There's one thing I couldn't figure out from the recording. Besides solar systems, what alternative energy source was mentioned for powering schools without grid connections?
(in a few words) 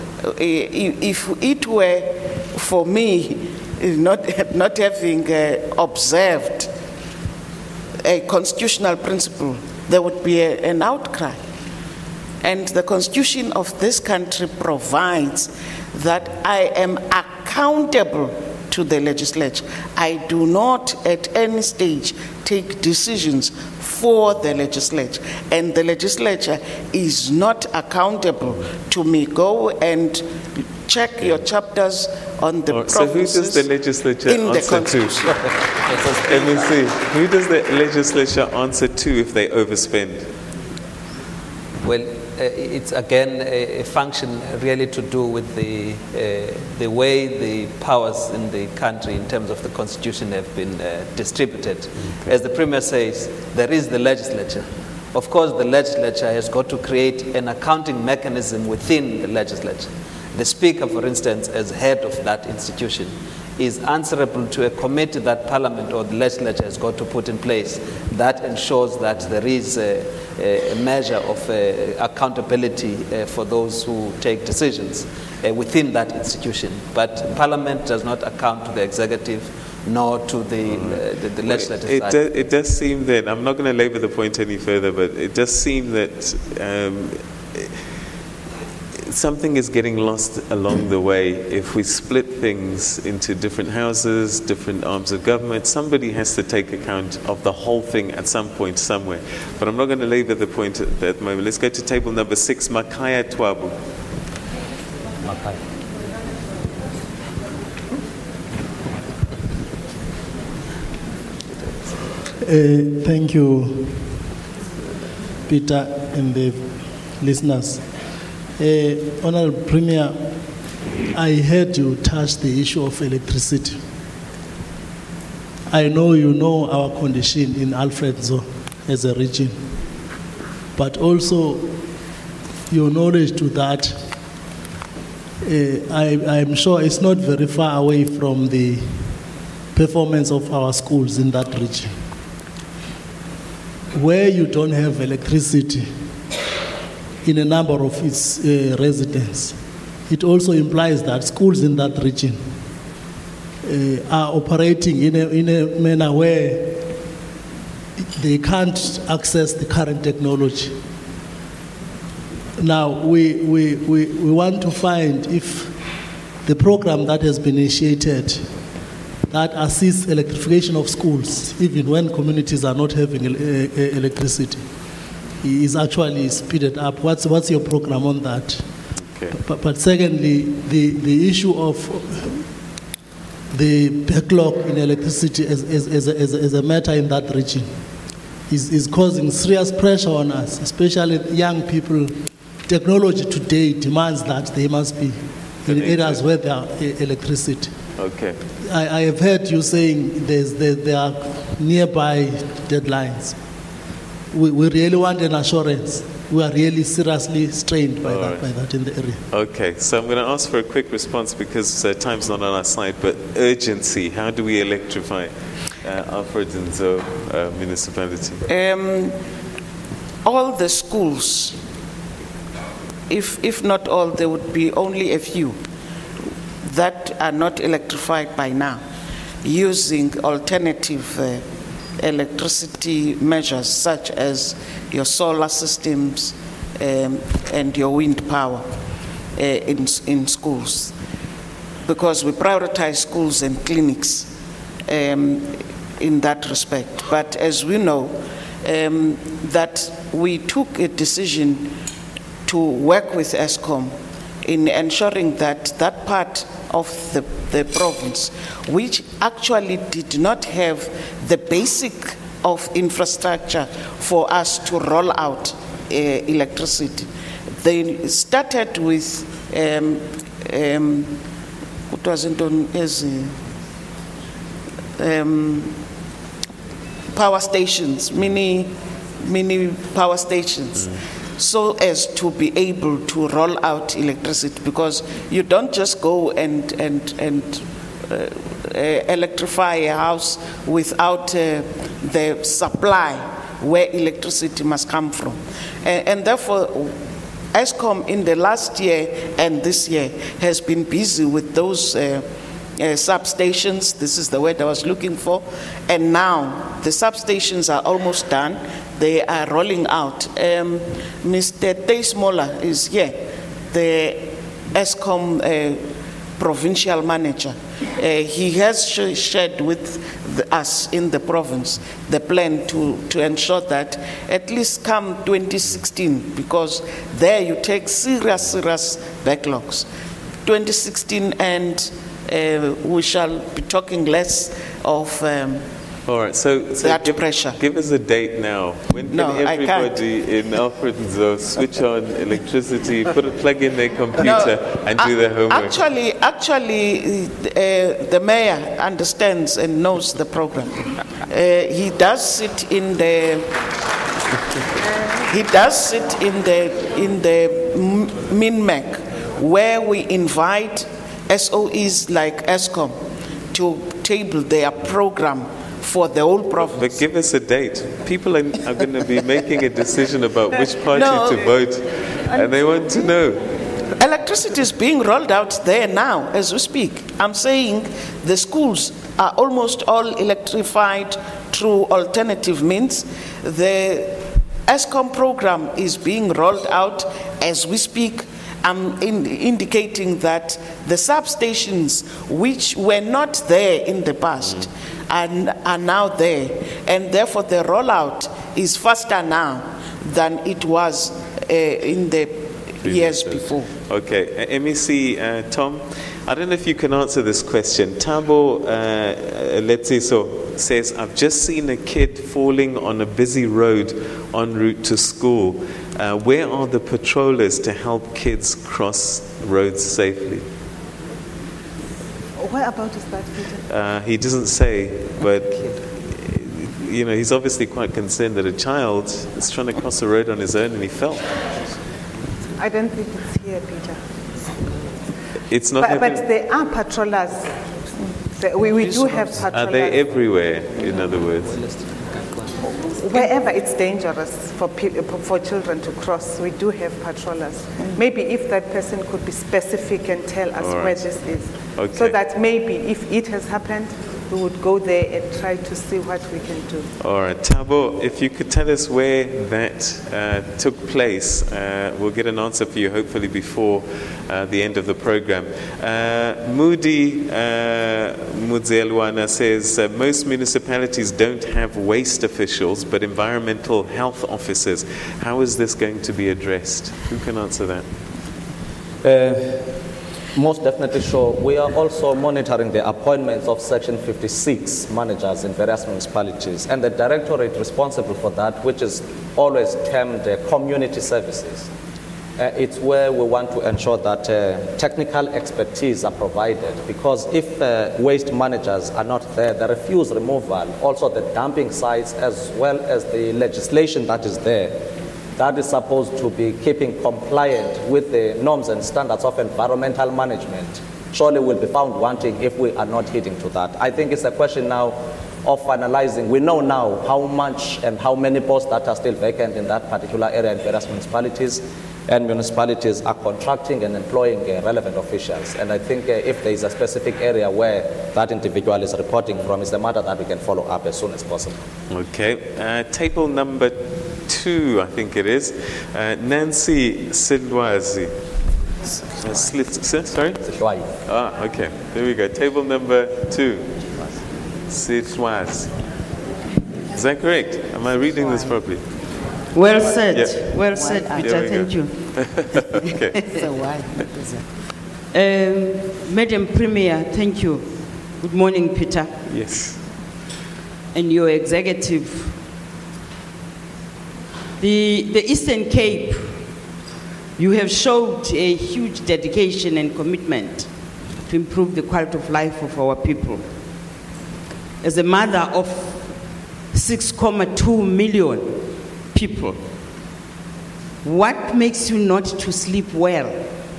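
wind power.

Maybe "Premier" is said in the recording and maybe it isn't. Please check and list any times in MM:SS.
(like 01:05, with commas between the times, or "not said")
00:52, 01:59, 09:16.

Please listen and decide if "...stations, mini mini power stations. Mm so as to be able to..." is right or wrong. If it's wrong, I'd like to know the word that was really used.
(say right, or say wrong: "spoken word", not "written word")
right.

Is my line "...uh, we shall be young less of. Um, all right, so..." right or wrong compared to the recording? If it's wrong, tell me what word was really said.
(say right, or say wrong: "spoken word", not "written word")
wrong: "talking", not "young".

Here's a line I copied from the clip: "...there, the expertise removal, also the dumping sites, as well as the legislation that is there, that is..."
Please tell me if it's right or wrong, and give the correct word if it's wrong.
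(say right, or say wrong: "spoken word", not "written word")
wrong: "refuse", not "expertise".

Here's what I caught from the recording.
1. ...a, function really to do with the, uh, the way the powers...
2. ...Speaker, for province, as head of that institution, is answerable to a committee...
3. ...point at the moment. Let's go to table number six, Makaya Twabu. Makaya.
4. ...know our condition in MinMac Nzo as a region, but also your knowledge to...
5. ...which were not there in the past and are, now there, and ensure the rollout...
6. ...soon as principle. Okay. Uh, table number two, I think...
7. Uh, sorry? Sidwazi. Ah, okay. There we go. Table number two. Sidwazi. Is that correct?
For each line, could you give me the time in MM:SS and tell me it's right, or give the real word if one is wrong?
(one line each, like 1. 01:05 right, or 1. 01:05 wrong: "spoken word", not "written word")
1. 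00:43 right
2. 01:00 wrong: "instance", not "province"
3. 01:40 right
4. 02:06 wrong: "Alfred", not "MinMac"
5. 06:32 wrong: "therefore", not "ensure"
6. 08:50 wrong: "possible", not "principle"
7. 08:58 right.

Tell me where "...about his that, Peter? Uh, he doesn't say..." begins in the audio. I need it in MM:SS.
07:02.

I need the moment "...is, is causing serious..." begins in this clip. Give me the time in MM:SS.
03:08.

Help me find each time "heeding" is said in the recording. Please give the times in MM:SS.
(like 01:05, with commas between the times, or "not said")
08:33.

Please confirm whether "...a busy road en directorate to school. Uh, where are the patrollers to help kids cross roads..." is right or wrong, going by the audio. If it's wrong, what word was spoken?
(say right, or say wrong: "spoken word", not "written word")
wrong: "route", not "directorate".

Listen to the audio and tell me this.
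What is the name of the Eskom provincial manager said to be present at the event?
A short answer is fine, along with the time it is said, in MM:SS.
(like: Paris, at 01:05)
Mr. Tay, at 05:11.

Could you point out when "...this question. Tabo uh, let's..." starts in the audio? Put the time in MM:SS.
06:47.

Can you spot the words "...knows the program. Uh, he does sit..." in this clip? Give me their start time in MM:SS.
05:49.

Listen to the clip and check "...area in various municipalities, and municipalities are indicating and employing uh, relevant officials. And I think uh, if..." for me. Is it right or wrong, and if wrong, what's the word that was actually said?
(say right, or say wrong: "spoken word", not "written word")
wrong: "contracting", not "indicating".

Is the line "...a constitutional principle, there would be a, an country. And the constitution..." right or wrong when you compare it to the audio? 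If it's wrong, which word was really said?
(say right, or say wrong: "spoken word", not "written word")
wrong: "outcry", not "country".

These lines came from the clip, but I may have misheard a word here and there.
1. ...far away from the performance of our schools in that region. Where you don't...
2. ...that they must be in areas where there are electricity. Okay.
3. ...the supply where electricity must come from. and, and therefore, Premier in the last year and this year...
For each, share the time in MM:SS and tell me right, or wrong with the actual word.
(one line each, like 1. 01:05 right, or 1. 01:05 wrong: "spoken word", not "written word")
1. 02:17 right
2. 03:14 right
3. 04:52 wrong: "Eskom", not "Premier".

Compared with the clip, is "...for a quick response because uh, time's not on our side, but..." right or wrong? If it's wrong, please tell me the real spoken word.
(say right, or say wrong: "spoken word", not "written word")
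right.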